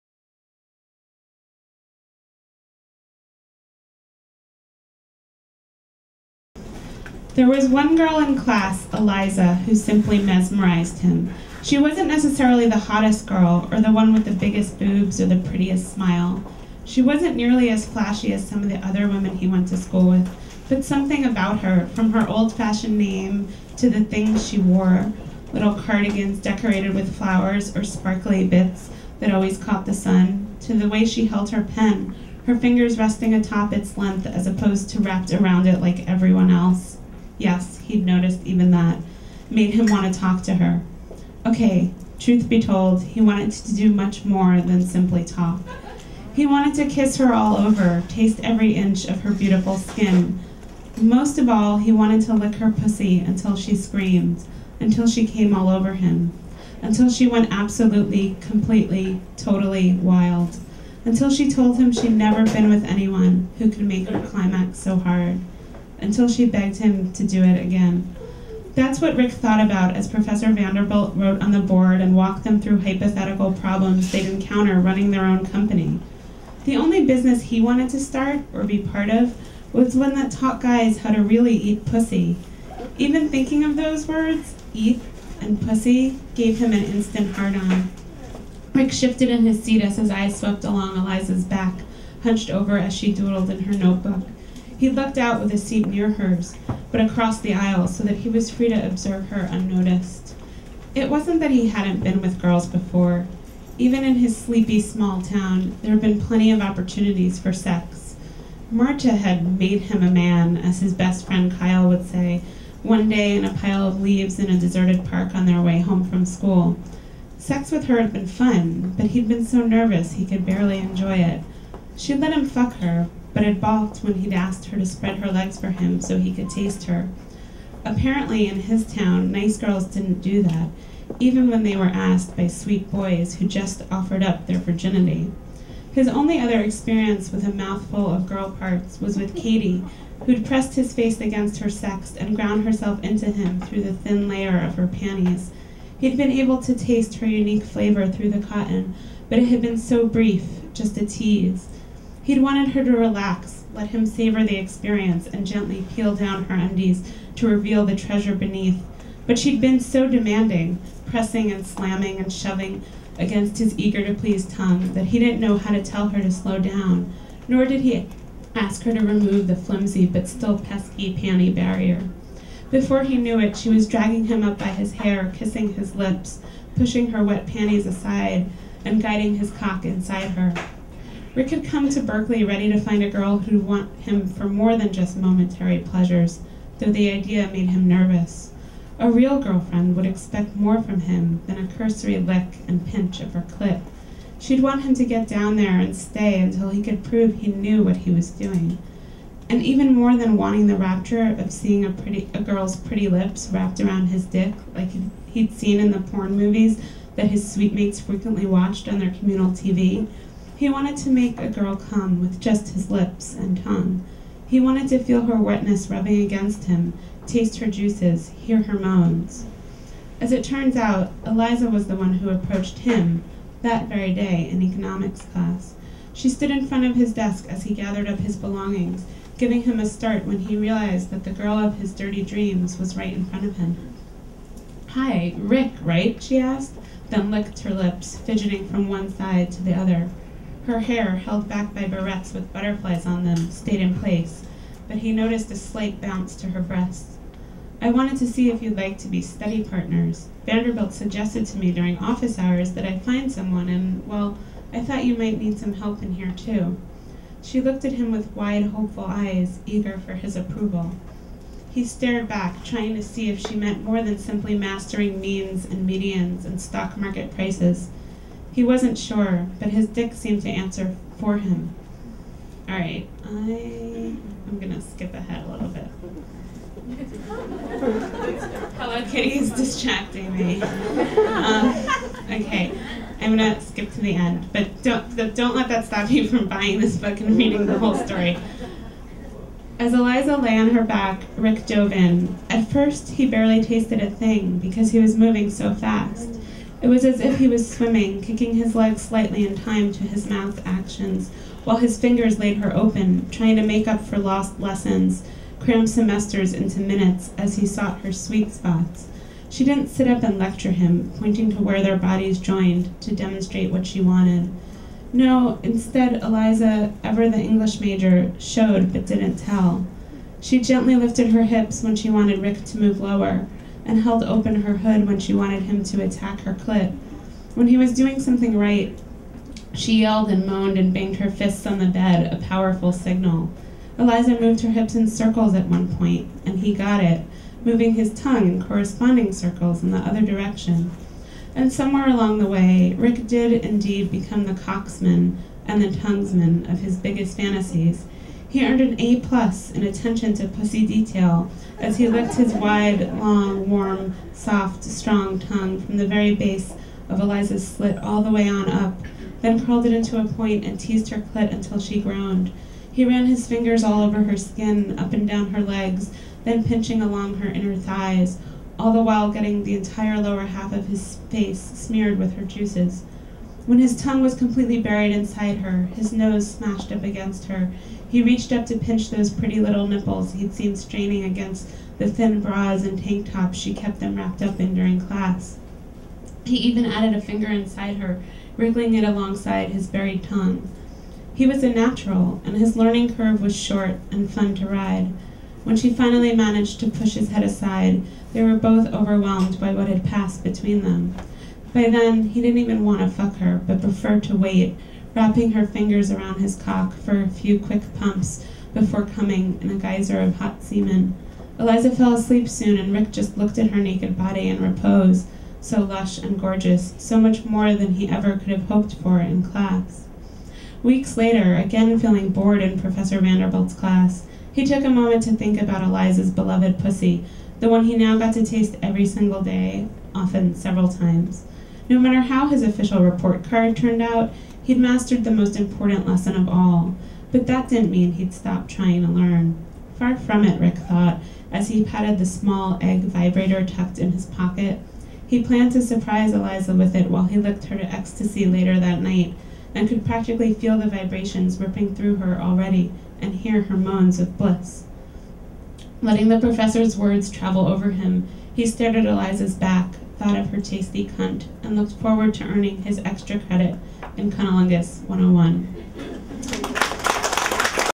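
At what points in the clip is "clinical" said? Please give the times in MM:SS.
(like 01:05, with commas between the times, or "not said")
not said.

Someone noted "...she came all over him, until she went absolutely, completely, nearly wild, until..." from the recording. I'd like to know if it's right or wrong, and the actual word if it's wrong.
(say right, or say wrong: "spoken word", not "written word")
wrong: "totally", not "nearly".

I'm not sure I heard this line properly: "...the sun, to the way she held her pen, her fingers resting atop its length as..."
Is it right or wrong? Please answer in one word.
right.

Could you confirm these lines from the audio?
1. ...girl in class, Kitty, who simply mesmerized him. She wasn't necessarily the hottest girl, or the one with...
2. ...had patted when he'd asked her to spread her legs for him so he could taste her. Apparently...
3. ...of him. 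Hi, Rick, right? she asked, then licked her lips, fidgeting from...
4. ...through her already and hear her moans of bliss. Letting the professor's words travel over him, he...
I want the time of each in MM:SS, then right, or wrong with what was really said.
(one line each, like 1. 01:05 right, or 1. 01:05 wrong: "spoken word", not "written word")
1. 00:07 wrong: "Eliza", not "Kitty"
2. 02:03 wrong: "balked", not "patted"
3. 03:53 right
4. 07:31 right.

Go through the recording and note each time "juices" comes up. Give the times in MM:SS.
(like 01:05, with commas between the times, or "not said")
03:37, 06:12.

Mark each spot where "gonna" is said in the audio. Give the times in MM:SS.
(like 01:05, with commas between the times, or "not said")
04:34, 04:43.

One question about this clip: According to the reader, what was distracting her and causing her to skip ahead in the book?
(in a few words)
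Hello Kitty.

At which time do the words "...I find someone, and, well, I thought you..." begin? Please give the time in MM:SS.
04:12.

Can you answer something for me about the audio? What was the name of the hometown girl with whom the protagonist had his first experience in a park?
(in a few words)
Marcia.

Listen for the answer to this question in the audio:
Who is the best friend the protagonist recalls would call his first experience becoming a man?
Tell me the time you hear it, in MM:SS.
01:51.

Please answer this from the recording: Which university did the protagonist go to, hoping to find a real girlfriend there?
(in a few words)
Berkeley.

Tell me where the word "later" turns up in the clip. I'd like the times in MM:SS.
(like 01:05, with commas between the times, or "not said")
07:01, 07:28.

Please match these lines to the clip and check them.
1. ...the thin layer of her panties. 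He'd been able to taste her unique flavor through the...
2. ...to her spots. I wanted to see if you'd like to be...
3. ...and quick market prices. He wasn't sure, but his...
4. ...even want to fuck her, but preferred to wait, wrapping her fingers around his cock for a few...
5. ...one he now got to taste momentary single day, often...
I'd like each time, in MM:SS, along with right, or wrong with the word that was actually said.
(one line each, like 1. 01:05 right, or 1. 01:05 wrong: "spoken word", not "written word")
1. 02:23 right
2. 04:06 wrong: "breasts", not "spots"
3. 04:26 wrong: "stock", not "quick"
4. 06:42 right
5. 07:07 wrong: "every", not "momentary".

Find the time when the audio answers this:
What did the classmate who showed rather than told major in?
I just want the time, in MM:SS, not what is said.
05:17.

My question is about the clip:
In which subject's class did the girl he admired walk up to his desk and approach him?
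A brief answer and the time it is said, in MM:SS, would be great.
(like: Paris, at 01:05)
Economics, at 03:44.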